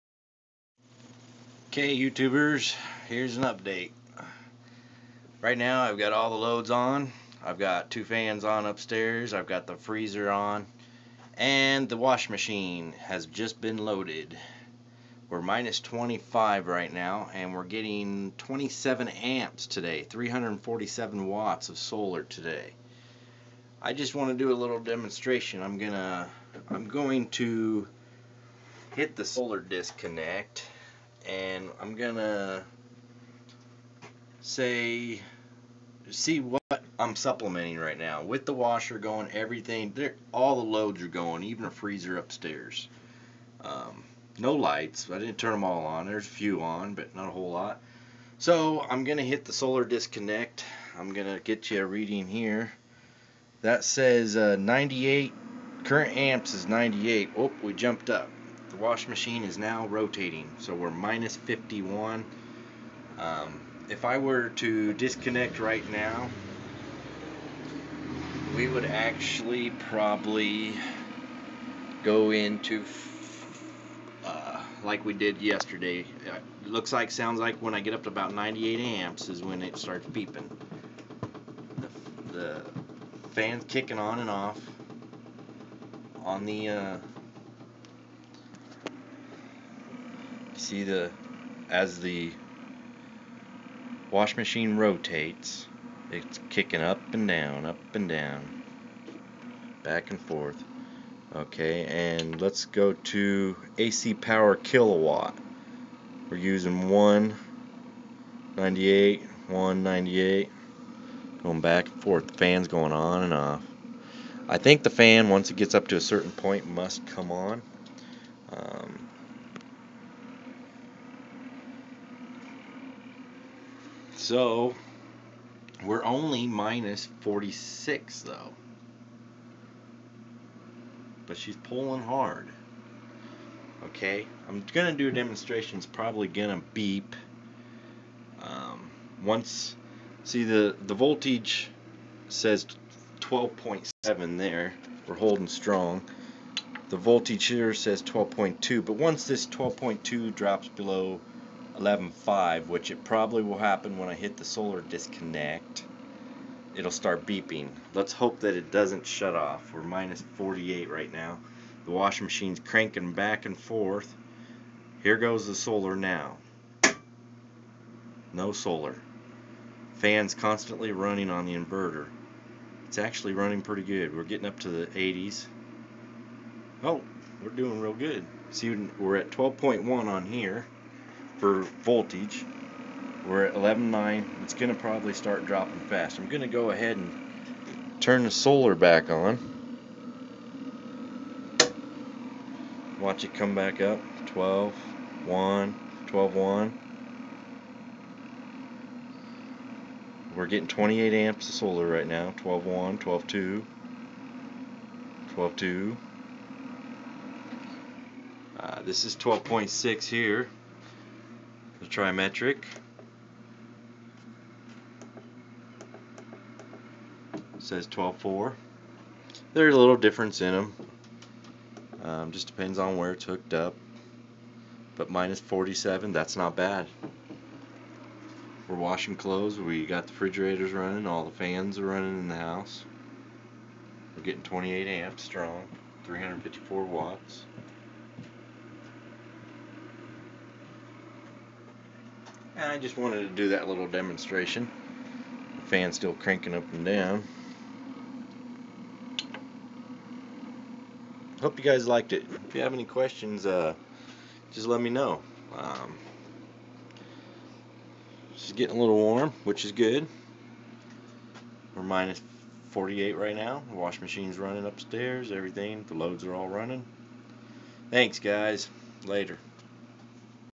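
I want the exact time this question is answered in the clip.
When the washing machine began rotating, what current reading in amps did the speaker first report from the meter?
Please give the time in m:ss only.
0:55.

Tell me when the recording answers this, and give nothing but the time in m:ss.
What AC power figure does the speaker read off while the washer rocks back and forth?
1:46.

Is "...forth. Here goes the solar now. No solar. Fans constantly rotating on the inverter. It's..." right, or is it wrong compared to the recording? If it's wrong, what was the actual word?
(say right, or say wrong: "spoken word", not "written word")
wrong: "running", not "rotating".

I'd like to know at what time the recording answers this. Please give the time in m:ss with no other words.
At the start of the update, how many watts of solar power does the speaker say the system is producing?
0:20.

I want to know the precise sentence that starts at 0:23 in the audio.
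I just want to do a little demonstration.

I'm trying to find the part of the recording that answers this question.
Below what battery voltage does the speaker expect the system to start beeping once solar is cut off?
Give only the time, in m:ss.
2:31.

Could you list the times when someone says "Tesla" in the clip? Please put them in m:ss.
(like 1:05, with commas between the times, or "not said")
not said.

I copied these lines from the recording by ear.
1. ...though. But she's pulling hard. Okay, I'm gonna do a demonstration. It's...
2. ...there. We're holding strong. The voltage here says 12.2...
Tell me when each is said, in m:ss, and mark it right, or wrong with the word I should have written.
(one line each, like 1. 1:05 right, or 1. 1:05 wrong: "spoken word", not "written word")
1. 2:08 right
2. 2:24 right.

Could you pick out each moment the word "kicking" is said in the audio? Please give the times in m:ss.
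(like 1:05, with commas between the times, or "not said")
1:23, 1:36.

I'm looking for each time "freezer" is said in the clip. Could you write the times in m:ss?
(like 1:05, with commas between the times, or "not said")
0:09, 0:41.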